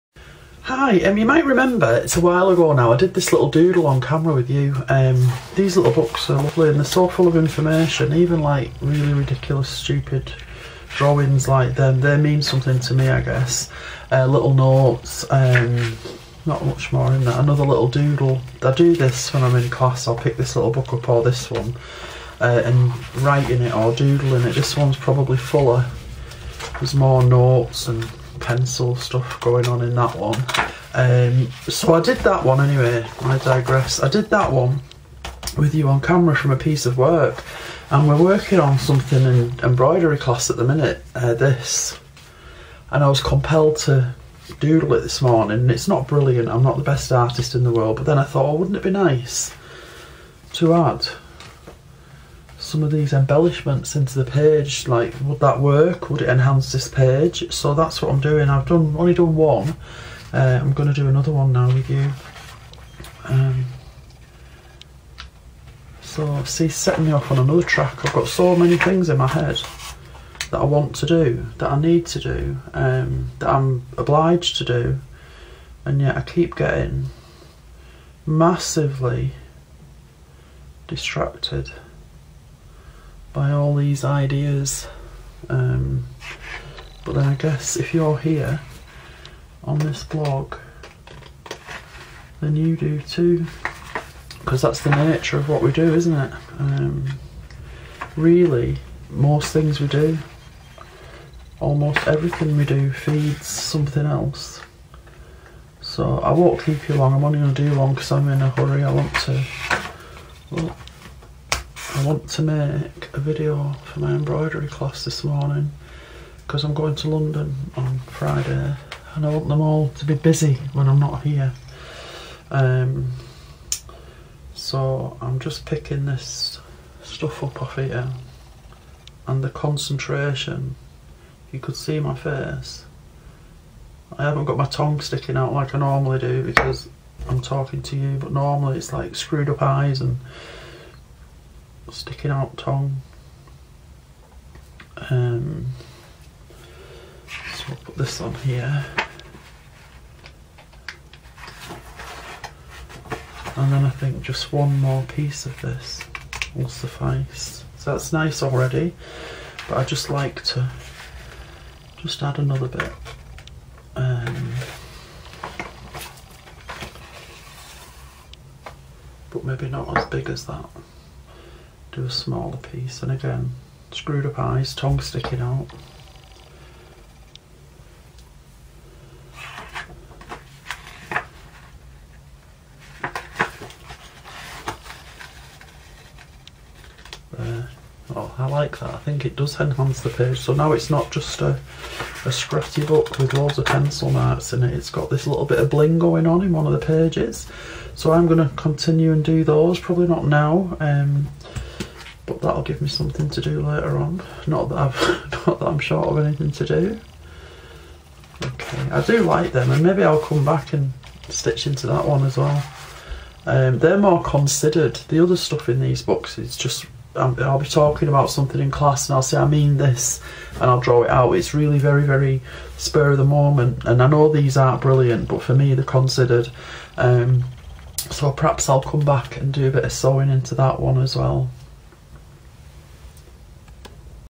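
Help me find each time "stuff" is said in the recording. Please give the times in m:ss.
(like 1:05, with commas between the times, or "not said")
0:28, 2:07, 3:35.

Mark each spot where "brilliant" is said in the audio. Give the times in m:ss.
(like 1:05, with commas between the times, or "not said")
0:46, 3:44.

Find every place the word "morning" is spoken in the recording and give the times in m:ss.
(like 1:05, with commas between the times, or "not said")
0:45, 1:55.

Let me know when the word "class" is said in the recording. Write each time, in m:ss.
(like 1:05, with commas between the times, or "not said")
0:19, 0:40, 1:54, 3:38.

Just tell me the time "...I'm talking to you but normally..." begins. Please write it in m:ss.
2:17.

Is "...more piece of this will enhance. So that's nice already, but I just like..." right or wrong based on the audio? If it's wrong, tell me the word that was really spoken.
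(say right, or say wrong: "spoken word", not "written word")
wrong: "suffice", not "enhance".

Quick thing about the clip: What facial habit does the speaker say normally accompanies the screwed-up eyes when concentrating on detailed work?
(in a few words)
Sticking out tongue.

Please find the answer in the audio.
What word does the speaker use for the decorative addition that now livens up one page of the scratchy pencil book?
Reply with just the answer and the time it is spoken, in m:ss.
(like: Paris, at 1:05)
Bling, at 3:15.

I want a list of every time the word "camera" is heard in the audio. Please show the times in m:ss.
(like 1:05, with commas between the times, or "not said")
0:03, 0:36.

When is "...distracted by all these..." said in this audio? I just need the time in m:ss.
1:20.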